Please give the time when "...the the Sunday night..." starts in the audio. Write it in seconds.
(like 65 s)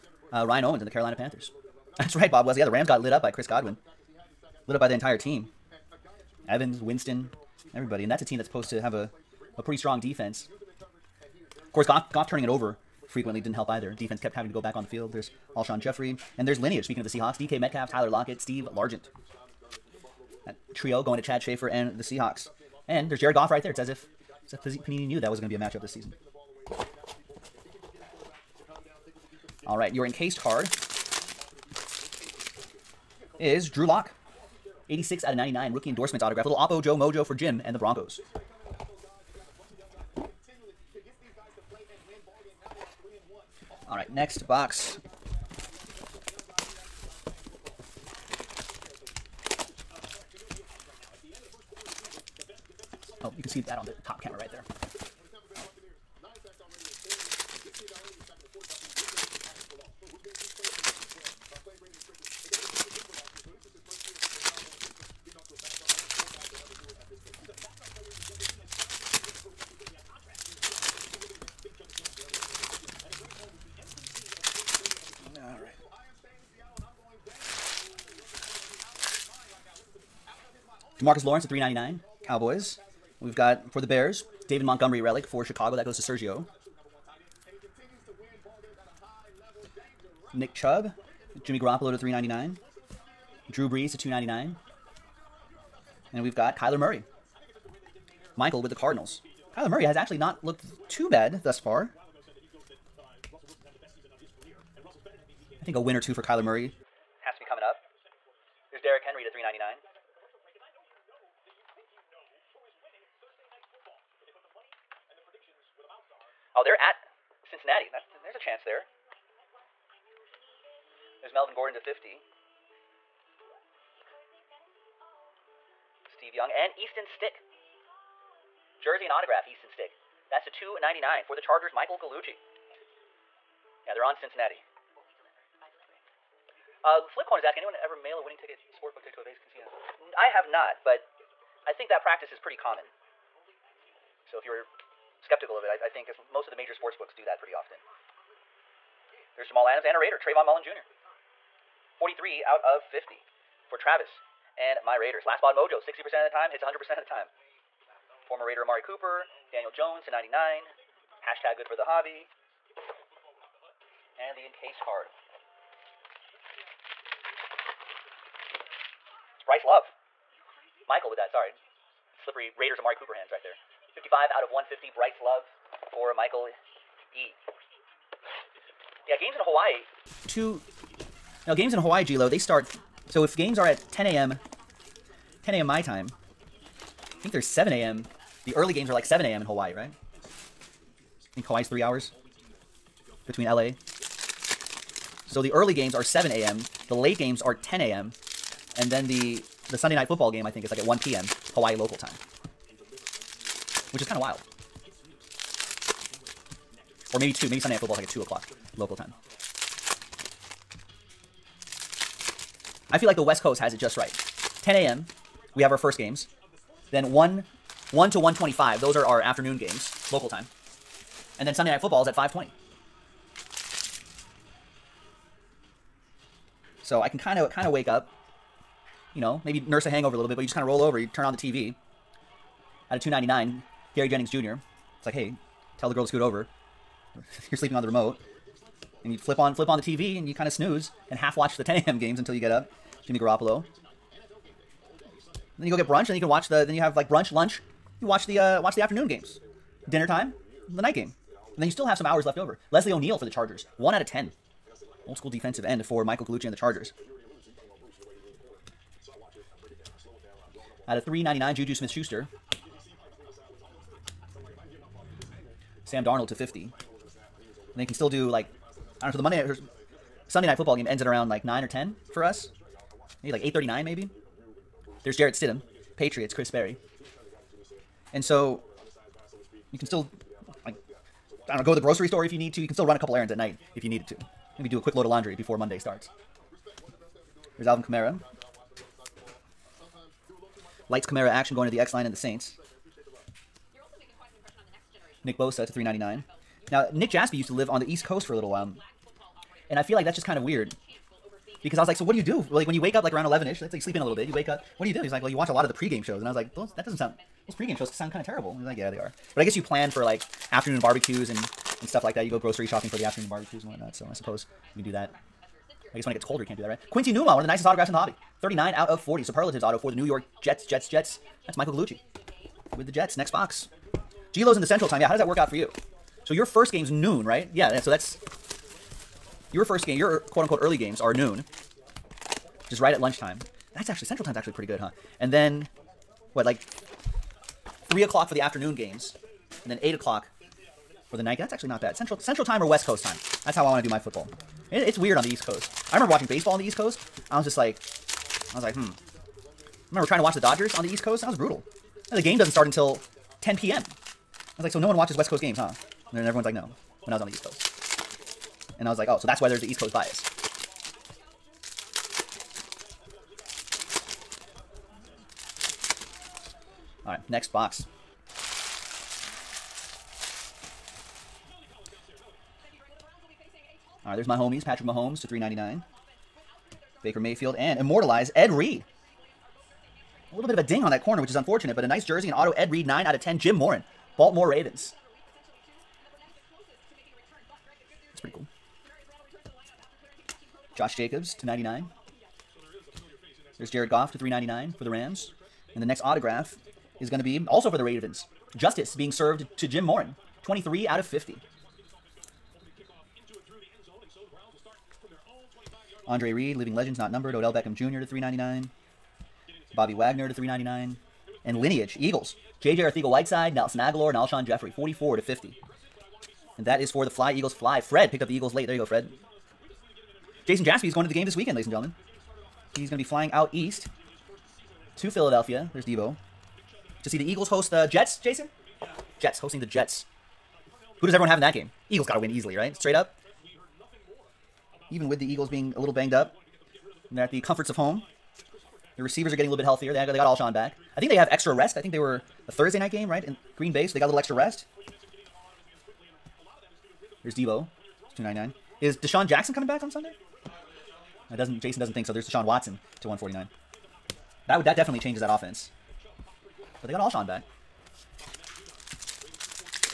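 199 s.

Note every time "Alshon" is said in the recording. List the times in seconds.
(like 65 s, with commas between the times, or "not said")
15 s, 414 s, 440 s, 456 s.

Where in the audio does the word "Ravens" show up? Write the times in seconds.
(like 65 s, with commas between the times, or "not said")
384 s, 397 s.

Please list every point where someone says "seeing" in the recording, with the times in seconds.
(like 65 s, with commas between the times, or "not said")
not said.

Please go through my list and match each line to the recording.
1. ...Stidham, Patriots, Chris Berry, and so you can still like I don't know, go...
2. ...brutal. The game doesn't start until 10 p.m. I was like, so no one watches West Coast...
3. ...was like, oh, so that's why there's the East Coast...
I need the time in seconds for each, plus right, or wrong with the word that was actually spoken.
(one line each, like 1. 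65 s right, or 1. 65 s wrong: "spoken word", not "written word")
1. 275 s right
2. 351 s right
3. 358 s right.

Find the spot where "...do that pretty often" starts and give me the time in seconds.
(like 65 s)
147 s.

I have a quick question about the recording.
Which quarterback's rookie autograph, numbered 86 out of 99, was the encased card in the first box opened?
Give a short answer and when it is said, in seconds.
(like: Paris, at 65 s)
Drew Lock, at 33 s.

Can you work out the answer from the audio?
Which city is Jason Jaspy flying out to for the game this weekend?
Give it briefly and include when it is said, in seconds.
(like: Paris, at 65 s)
Philadelphia, at 425 s.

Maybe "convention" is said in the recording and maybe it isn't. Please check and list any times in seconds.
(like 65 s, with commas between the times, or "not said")
not said.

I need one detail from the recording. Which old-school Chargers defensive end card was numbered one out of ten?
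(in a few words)
Leslie O'Neal.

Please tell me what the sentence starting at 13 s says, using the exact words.
Defense kept having to go back on the field.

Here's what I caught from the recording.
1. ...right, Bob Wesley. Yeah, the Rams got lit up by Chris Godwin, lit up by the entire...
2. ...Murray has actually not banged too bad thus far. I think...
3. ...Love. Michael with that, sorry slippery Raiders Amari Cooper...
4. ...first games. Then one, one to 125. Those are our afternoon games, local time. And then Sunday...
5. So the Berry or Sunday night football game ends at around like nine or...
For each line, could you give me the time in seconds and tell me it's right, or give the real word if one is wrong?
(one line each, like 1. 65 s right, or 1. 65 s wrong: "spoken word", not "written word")
1. 2 s right
2. 99 s wrong: "looked", not "banged"
3. 169 s right
4. 215 s right
5. 269 s wrong: "Monday", not "Berry".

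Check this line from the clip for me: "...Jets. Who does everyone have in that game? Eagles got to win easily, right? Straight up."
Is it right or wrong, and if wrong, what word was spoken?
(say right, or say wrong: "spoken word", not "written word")
right.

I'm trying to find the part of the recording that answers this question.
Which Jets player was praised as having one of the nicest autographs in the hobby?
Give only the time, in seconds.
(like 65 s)
316 s.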